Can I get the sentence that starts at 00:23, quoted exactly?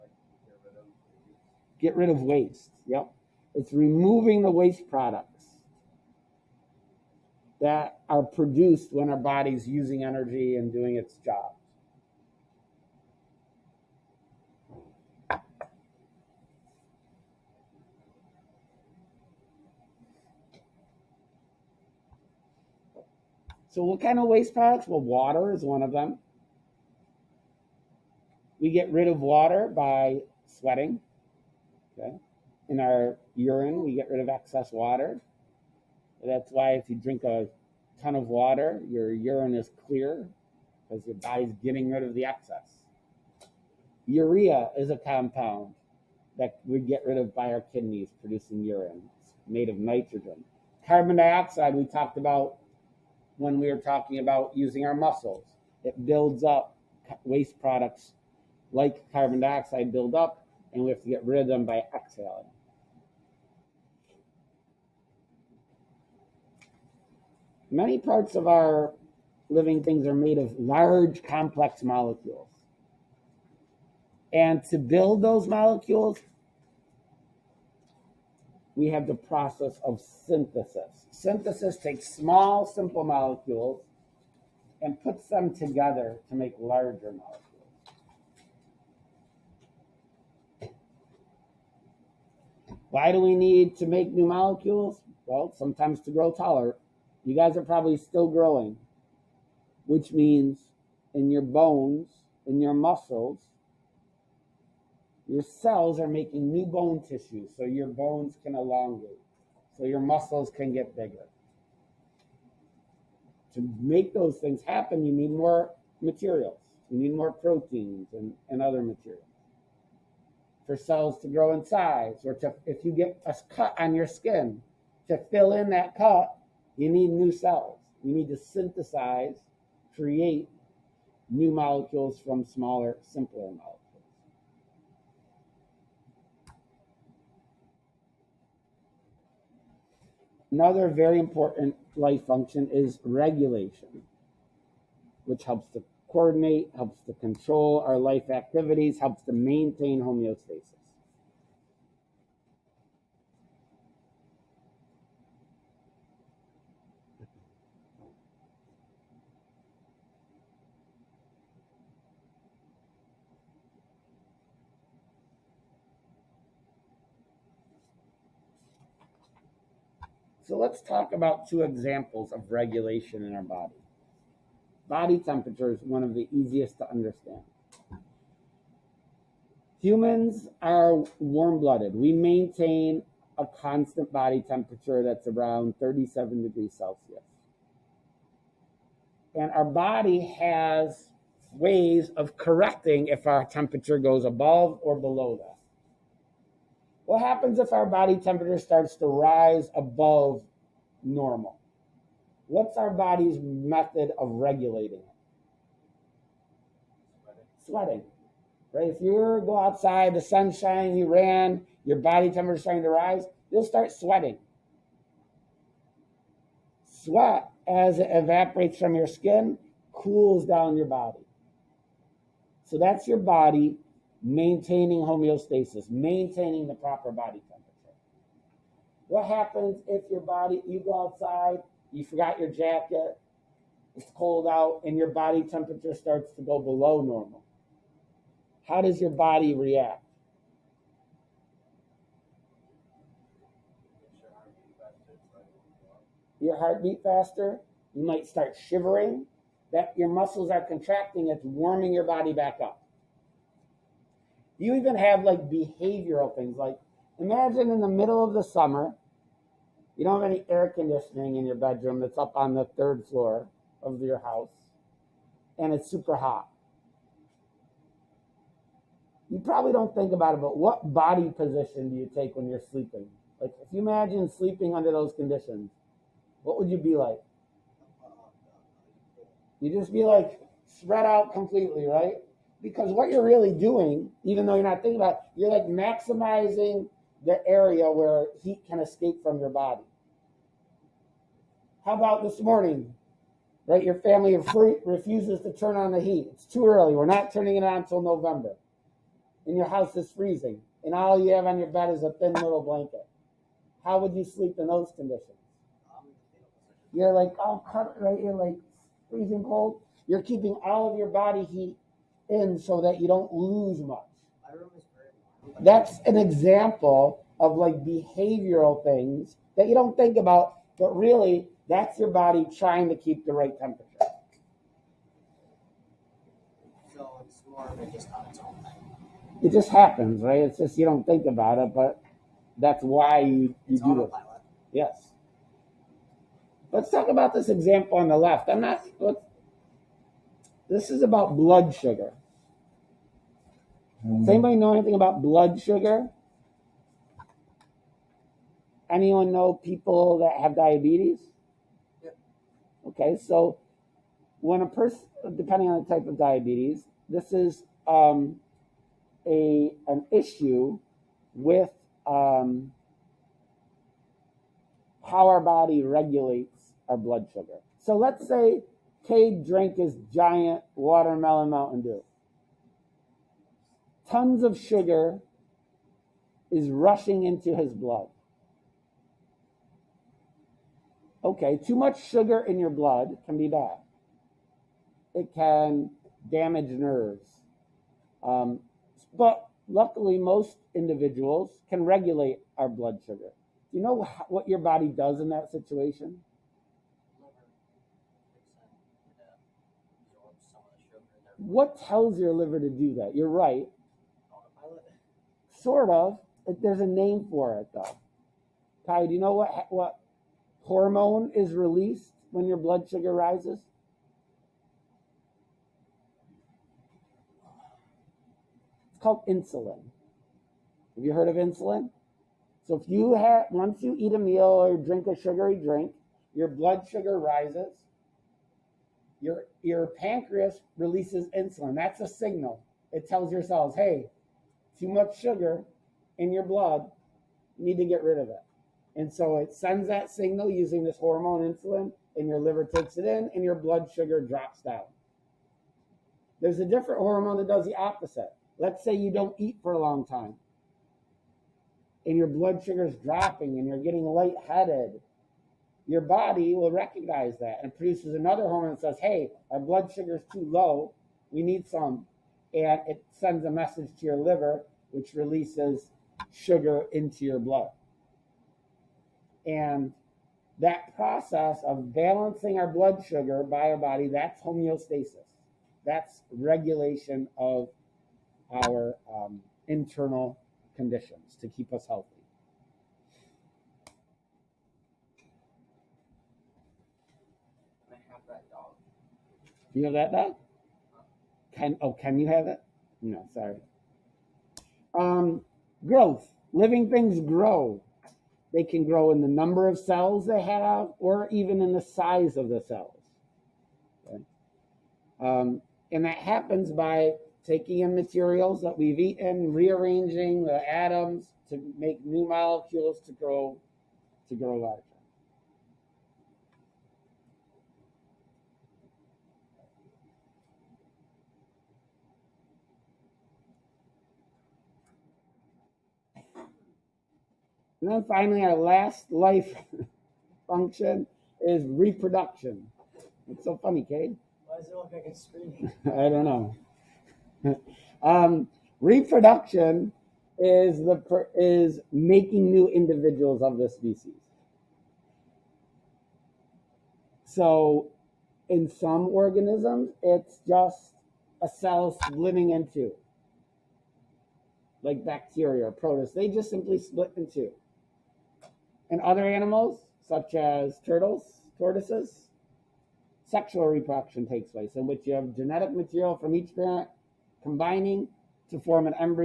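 So, what kind of waste products?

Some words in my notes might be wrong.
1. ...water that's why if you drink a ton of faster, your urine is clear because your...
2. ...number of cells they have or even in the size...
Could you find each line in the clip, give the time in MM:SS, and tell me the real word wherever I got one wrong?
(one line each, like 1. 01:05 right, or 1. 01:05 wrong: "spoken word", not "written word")
1. 00:34 wrong: "water", not "faster"
2. 08:19 right.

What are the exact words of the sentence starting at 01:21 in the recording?
Synthesis takes small, simple molecules and puts them together to make larger molecules.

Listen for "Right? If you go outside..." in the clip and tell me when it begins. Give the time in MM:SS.
03:28.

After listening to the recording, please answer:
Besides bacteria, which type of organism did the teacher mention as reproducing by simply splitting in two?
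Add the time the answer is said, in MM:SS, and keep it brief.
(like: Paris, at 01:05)
Protists, at 09:15.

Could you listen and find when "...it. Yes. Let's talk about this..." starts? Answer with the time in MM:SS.
05:34.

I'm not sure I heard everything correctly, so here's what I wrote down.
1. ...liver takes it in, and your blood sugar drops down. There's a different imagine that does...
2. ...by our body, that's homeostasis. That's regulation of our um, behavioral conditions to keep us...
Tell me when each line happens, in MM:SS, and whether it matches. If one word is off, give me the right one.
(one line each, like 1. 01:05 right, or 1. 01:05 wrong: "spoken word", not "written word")
1. 07:22 wrong: "hormone", not "imagine"
2. 07:53 wrong: "internal", not "behavioral".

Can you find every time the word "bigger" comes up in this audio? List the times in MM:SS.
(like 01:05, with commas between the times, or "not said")
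01:50.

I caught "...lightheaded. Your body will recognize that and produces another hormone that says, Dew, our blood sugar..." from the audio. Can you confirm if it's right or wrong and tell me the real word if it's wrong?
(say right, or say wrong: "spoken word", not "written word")
wrong: "Hey", not "Dew".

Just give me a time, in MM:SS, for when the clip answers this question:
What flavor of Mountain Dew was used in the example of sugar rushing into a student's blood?
06:10.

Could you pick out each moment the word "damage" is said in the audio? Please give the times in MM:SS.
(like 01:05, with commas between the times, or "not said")
06:26.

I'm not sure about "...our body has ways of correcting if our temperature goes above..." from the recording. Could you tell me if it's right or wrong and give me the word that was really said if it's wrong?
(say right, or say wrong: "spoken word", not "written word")
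right.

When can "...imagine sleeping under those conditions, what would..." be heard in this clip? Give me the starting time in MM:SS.
04:33.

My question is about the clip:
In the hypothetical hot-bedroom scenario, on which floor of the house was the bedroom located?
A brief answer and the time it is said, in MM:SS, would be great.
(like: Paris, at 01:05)
Third floor, at 04:22.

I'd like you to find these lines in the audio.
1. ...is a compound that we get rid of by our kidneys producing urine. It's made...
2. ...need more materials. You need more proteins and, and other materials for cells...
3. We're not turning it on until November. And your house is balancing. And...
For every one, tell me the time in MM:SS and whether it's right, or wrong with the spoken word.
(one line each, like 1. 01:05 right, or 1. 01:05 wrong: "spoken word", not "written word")
1. 00:44 right
2. 01:55 right
3. 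04:56 wrong: "freezing", not "balancing".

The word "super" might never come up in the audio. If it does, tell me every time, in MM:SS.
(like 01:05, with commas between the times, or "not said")
04:25.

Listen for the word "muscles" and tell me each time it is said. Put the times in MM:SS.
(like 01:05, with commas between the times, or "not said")
00:54, 01:42, 01:50, 04:10.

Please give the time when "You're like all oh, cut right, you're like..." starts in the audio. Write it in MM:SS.
05:06.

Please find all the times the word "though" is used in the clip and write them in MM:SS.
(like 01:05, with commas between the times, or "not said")
04:44, 06:47.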